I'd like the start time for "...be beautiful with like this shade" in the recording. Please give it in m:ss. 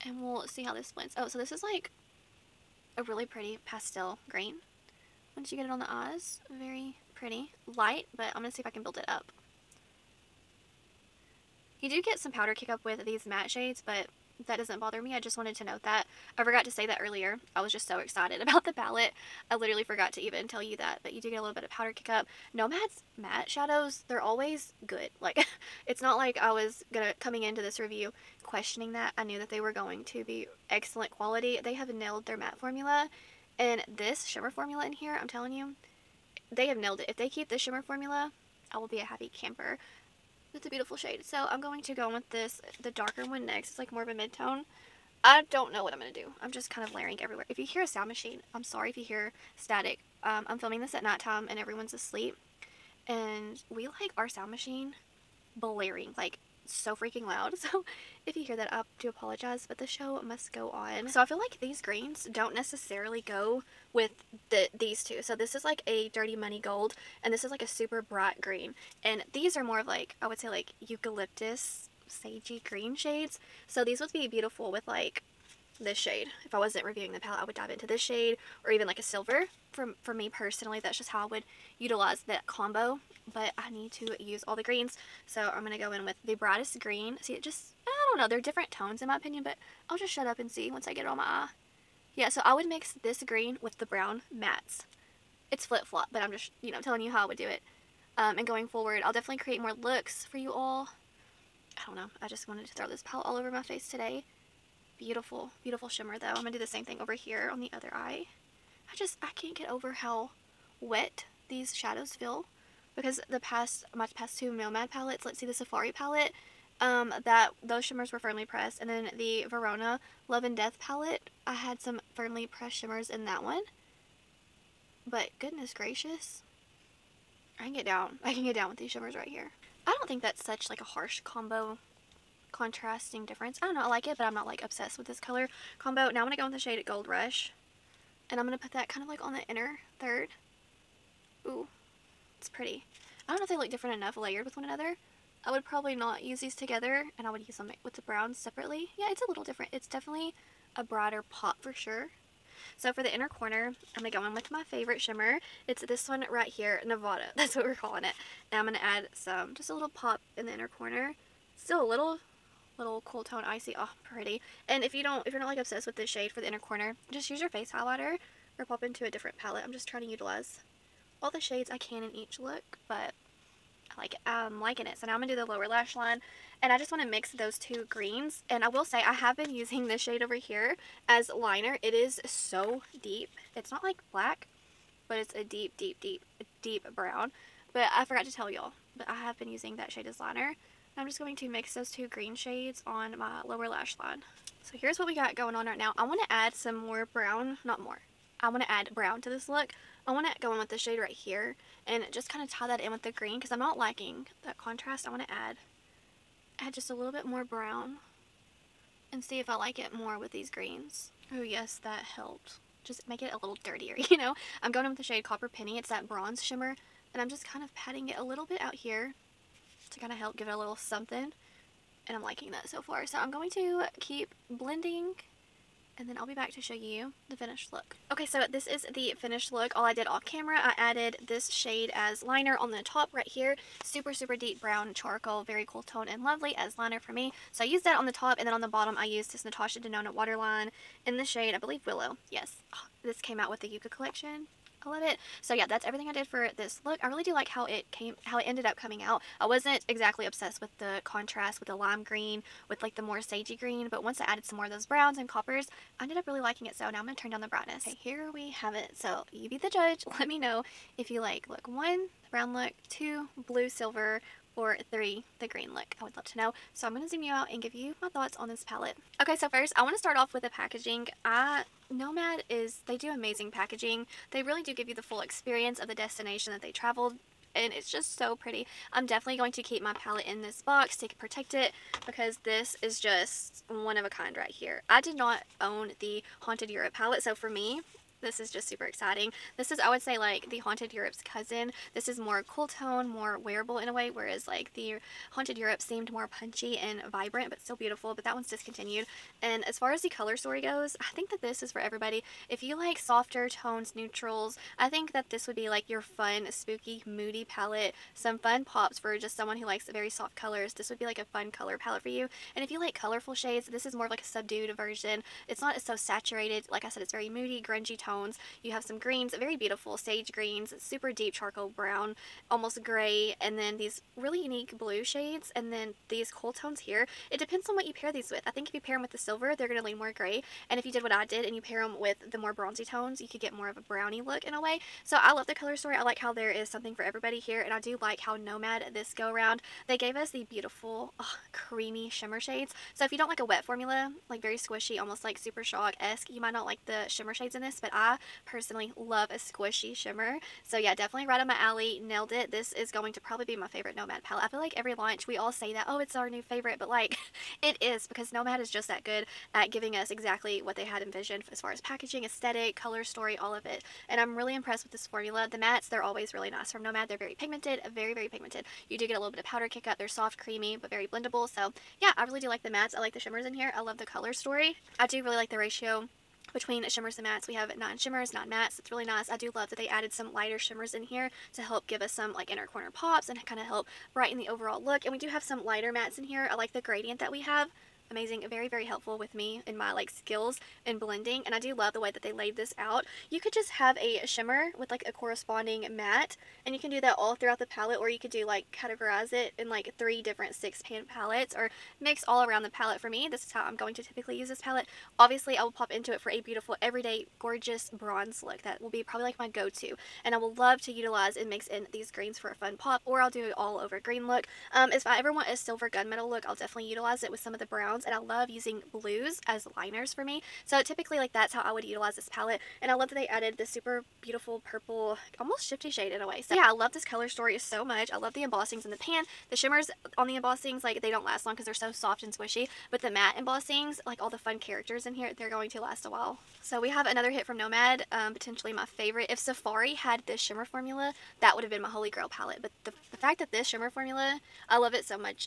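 1:14.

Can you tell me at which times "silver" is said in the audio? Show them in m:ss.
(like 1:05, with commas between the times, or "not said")
1:19, 4:23, 5:29, 6:55.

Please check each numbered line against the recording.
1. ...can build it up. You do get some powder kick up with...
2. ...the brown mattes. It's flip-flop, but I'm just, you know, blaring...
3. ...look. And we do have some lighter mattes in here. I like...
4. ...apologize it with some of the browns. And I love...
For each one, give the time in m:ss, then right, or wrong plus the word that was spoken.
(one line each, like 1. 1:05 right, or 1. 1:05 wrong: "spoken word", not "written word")
1. 0:08 right
2. 1:33 wrong: "telling", not "blaring"
3. 6:24 right
4. 6:56 wrong: "utilize", not "apologize".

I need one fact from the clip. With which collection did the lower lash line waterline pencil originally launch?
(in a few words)
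Yucca.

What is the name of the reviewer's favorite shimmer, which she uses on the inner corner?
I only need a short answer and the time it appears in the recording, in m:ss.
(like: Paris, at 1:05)
Nevada, at 2:36.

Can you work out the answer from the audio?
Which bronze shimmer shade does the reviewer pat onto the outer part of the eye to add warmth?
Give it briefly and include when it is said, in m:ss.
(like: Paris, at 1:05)
Copper Penny, at 3:35.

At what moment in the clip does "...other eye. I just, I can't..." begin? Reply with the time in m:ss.
1:47.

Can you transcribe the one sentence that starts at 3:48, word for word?
Okay, so this is the finished look.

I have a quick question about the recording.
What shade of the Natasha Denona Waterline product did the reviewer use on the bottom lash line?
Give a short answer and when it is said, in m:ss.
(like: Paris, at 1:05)
Willow, at 4:01.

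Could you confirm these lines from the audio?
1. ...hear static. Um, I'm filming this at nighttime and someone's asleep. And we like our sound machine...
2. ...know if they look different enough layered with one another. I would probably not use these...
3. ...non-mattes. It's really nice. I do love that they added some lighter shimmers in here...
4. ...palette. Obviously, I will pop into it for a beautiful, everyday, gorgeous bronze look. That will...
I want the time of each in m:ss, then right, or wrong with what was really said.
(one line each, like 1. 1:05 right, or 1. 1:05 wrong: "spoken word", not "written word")
1. 0:49 wrong: "everyone", not "someone"
2. 2:23 right
3. 6:18 right
4. 6:44 right.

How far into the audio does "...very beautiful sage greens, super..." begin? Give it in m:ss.
5:19.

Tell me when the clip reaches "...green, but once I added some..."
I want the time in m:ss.
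4:13.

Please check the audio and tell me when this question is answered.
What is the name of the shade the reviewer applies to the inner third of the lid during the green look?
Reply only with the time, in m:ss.
2:16.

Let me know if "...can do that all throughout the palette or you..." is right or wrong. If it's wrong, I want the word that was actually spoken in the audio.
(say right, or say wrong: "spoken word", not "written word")
right.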